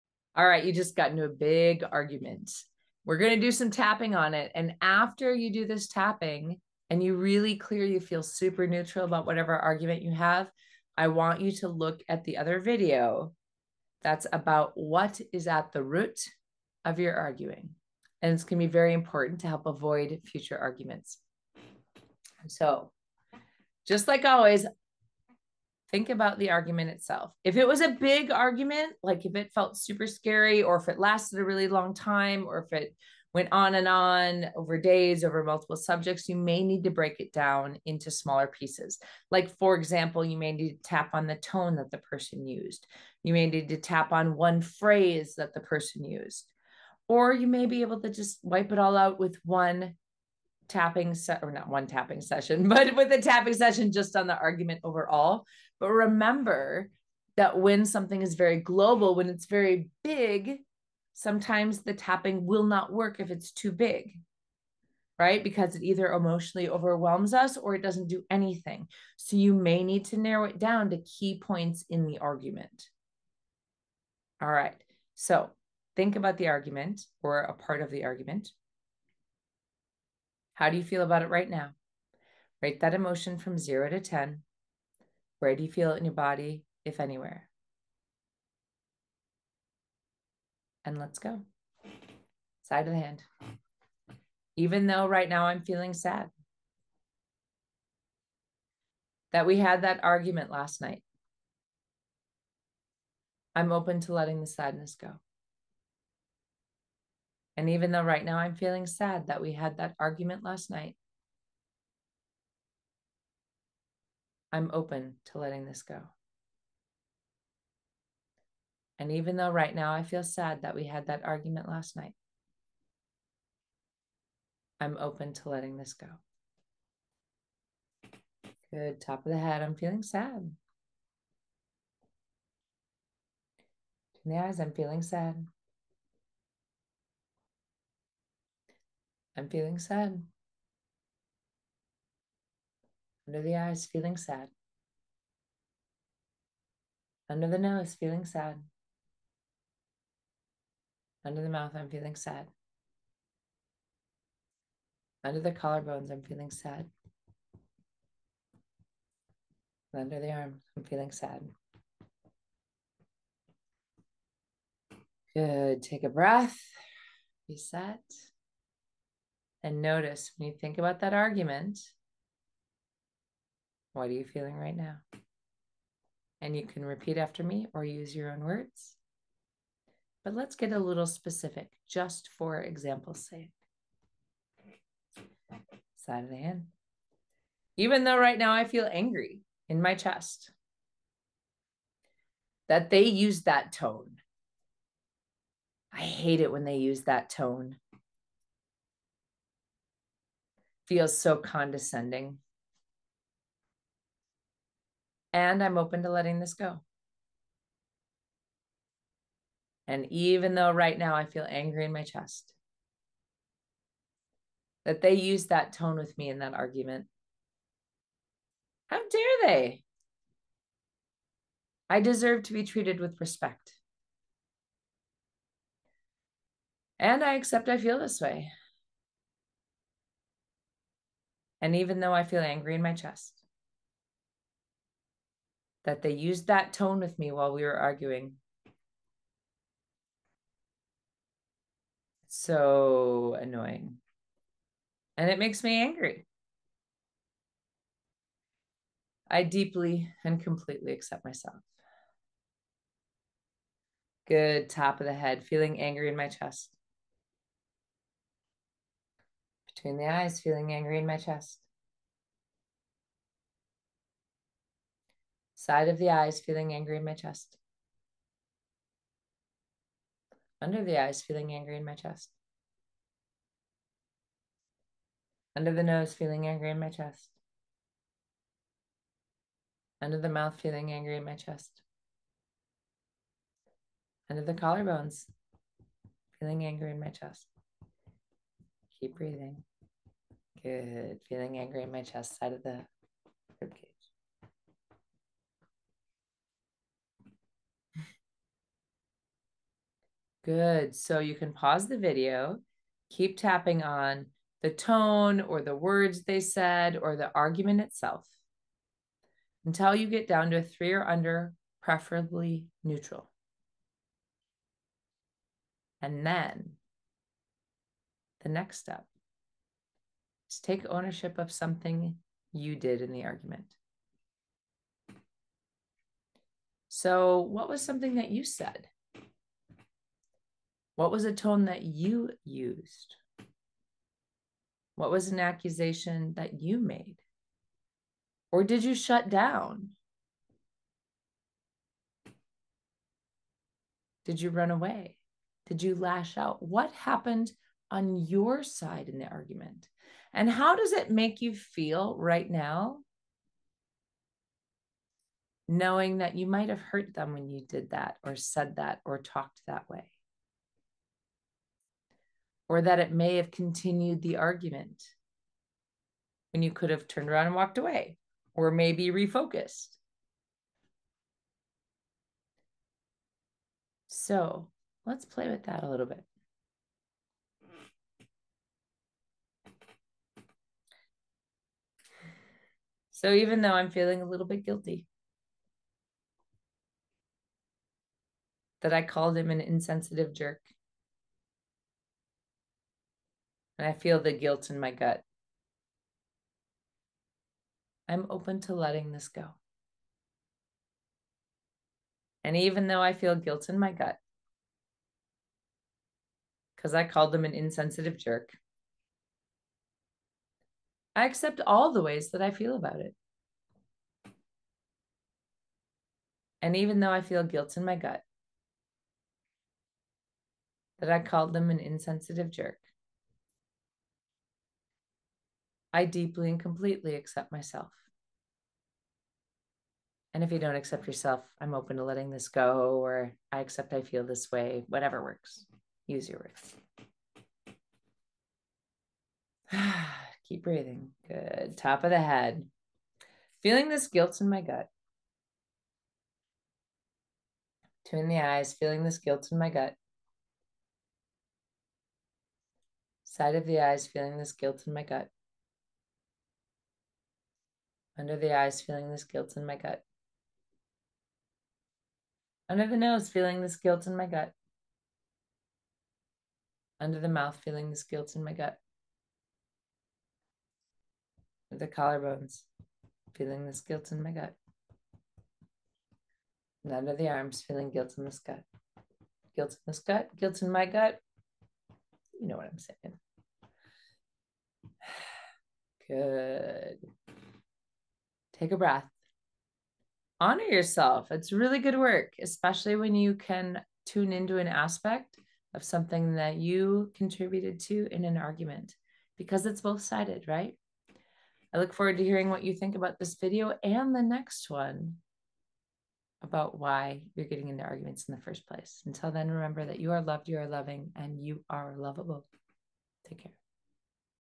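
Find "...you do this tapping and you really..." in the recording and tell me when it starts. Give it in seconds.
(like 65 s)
5 s.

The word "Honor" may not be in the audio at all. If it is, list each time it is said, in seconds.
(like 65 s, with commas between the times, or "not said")
490 s.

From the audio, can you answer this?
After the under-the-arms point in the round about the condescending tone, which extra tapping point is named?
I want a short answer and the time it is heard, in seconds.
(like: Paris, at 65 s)
side of the ribcage, at 292 s.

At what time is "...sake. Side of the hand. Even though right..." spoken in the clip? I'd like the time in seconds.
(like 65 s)
183 s.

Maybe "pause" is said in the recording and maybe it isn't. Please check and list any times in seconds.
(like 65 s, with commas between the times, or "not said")
301 s.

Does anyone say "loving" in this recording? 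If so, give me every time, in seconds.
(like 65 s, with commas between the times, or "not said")
510 s.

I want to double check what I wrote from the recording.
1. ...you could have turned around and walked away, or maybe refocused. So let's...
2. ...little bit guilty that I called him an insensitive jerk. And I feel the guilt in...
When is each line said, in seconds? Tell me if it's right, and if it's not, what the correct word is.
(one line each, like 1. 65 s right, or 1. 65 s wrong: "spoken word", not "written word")
1. 366 s right
2. 384 s right.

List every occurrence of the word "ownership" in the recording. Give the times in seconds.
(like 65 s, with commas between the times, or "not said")
320 s.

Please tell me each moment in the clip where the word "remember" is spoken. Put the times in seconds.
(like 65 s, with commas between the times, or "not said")
55 s, 509 s.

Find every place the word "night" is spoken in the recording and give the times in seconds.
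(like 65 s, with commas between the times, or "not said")
100 s, 110 s, 121 s.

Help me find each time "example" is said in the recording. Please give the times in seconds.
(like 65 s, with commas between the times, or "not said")
39 s, 182 s.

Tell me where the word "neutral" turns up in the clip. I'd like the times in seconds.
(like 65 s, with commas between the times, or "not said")
8 s, 312 s.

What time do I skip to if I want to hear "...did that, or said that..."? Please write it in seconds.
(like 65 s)
357 s.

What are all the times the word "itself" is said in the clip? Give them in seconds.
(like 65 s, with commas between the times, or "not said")
26 s, 307 s.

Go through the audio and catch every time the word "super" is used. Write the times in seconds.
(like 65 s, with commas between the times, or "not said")
8 s, 29 s.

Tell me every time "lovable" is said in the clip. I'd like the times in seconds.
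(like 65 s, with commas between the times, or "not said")
511 s.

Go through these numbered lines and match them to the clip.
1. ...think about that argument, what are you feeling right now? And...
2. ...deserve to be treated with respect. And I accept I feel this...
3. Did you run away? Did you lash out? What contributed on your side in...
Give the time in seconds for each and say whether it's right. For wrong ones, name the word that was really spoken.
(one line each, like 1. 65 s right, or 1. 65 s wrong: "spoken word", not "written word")
1. 170 s right
2. 222 s right
3. 344 s wrong: "happened", not "contributed".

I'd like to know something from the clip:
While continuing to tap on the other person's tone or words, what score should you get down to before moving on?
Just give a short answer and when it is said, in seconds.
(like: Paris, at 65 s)
3, at 310 s.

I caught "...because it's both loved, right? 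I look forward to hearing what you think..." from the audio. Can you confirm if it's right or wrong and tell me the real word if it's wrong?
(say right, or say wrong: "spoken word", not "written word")
wrong: "sided", not "loved".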